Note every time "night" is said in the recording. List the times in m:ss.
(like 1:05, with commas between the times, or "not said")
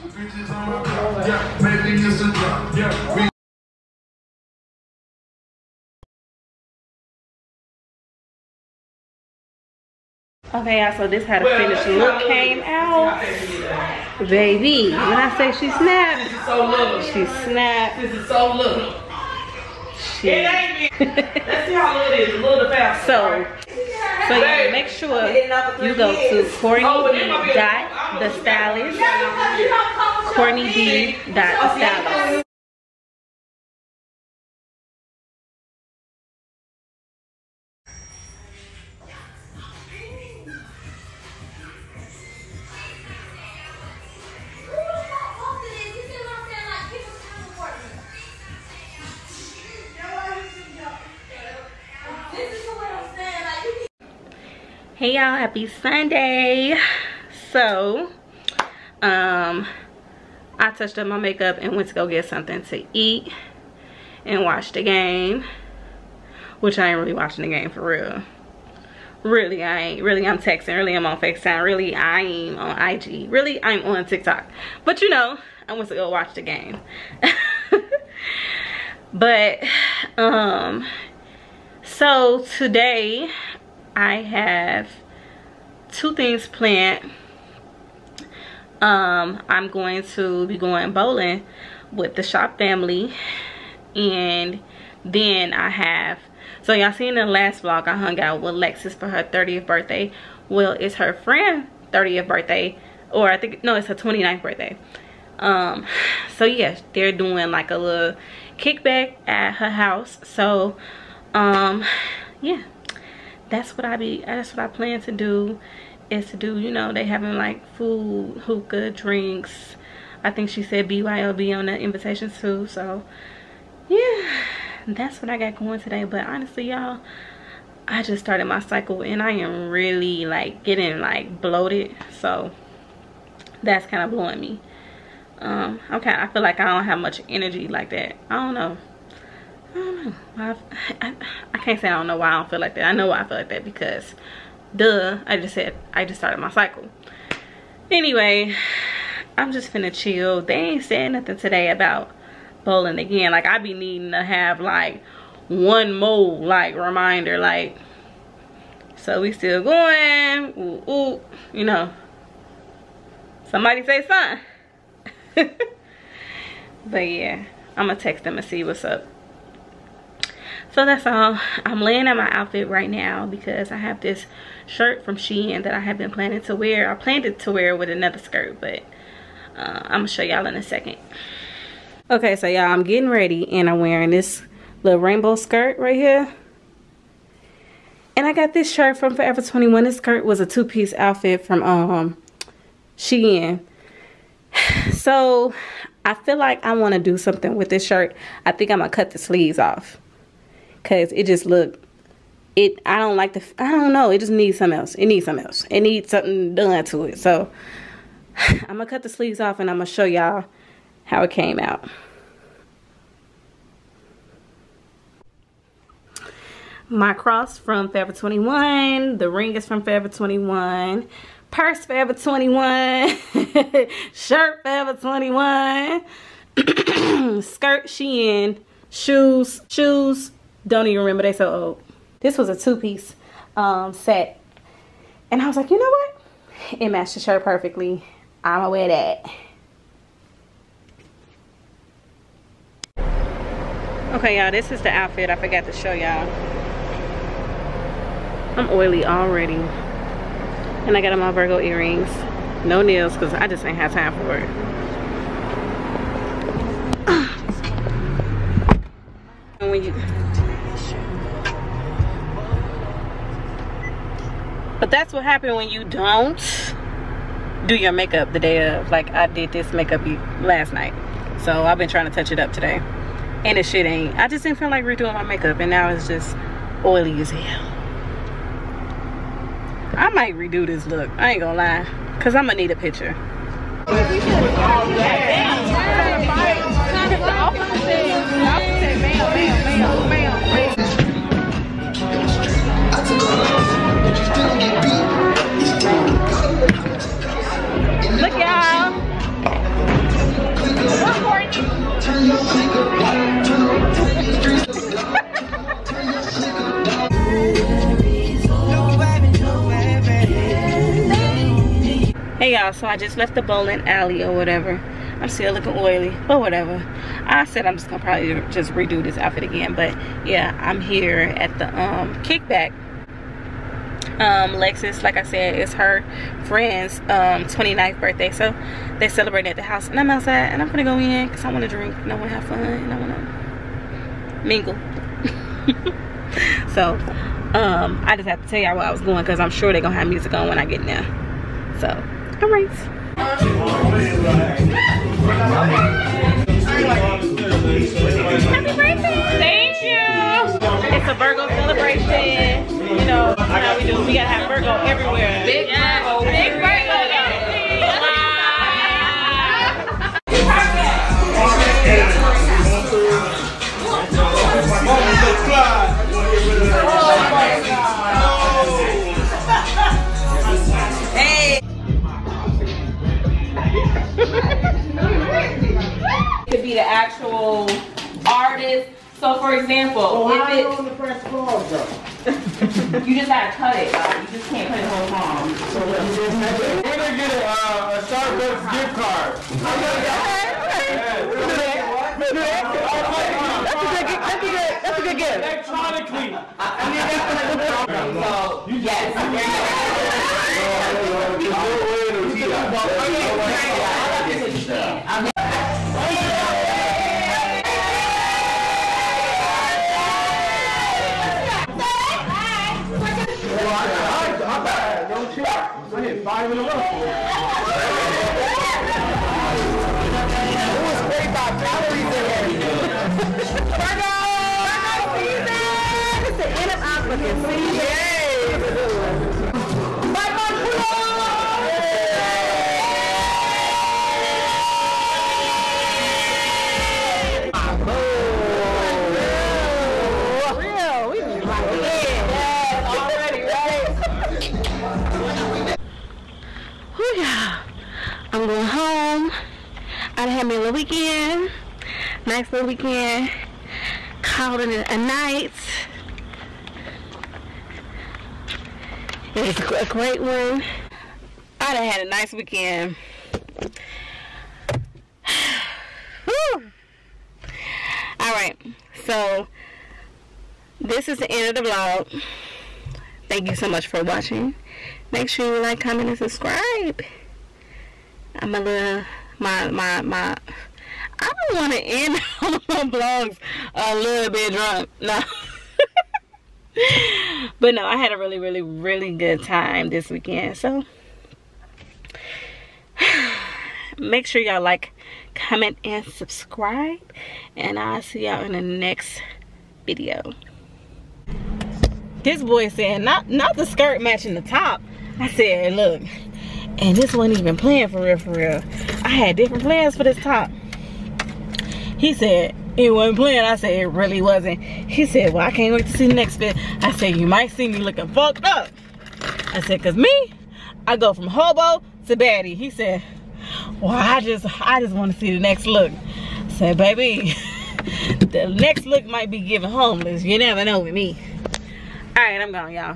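4:30, 7:34.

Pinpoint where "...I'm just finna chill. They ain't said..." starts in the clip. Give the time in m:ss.
2:29.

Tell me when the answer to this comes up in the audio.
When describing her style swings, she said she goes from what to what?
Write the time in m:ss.
8:41.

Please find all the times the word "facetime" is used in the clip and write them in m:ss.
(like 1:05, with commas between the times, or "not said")
1:11.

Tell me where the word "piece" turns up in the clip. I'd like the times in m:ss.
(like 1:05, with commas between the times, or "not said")
3:10, 3:52.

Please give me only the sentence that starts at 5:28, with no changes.
So they celebrating at the house.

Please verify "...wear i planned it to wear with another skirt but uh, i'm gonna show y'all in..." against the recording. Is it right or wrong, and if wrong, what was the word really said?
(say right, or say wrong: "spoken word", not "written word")
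right.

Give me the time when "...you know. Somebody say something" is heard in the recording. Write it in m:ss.
2:41.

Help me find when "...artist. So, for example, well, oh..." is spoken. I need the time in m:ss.
6:18.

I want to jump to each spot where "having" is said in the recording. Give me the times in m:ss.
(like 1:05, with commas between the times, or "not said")
1:57.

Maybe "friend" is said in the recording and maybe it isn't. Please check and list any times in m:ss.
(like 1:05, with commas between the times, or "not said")
1:41, 5:26.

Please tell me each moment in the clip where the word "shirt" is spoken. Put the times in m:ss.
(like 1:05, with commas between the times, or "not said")
2:54, 3:08, 3:17, 3:44, 3:57.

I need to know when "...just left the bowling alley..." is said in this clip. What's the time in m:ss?
5:12.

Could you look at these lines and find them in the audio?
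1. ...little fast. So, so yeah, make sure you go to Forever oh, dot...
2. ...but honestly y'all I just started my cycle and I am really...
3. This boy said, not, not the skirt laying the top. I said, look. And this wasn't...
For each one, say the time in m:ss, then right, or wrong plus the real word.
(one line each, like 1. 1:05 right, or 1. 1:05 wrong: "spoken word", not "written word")
1. 0:22 wrong: "Courtney", not "Forever"
2. 2:06 right
3. 8:22 wrong: "matching", not "laying".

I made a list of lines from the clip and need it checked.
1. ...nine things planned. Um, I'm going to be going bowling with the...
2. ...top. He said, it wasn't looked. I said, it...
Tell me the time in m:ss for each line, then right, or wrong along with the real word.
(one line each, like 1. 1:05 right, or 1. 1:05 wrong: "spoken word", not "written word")
1. 1:25 wrong: "two", not "nine"
2. 8:30 wrong: "planned", not "looked".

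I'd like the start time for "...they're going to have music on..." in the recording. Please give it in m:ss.
5:39.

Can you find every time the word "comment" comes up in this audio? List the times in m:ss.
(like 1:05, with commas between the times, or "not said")
7:55, 8:15.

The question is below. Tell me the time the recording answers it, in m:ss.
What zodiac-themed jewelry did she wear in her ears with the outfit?
4:10.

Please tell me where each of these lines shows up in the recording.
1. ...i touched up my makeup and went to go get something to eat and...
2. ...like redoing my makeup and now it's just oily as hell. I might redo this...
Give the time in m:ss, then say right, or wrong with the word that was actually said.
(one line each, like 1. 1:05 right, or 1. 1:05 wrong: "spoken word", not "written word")
1. 1:00 right
2. 4:34 right.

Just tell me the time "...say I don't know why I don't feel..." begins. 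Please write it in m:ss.
2:21.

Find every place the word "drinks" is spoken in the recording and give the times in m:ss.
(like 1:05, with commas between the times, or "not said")
1:58, 5:31.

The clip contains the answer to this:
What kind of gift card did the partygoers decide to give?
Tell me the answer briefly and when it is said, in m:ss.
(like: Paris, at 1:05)
Starbucks gift card, at 6:27.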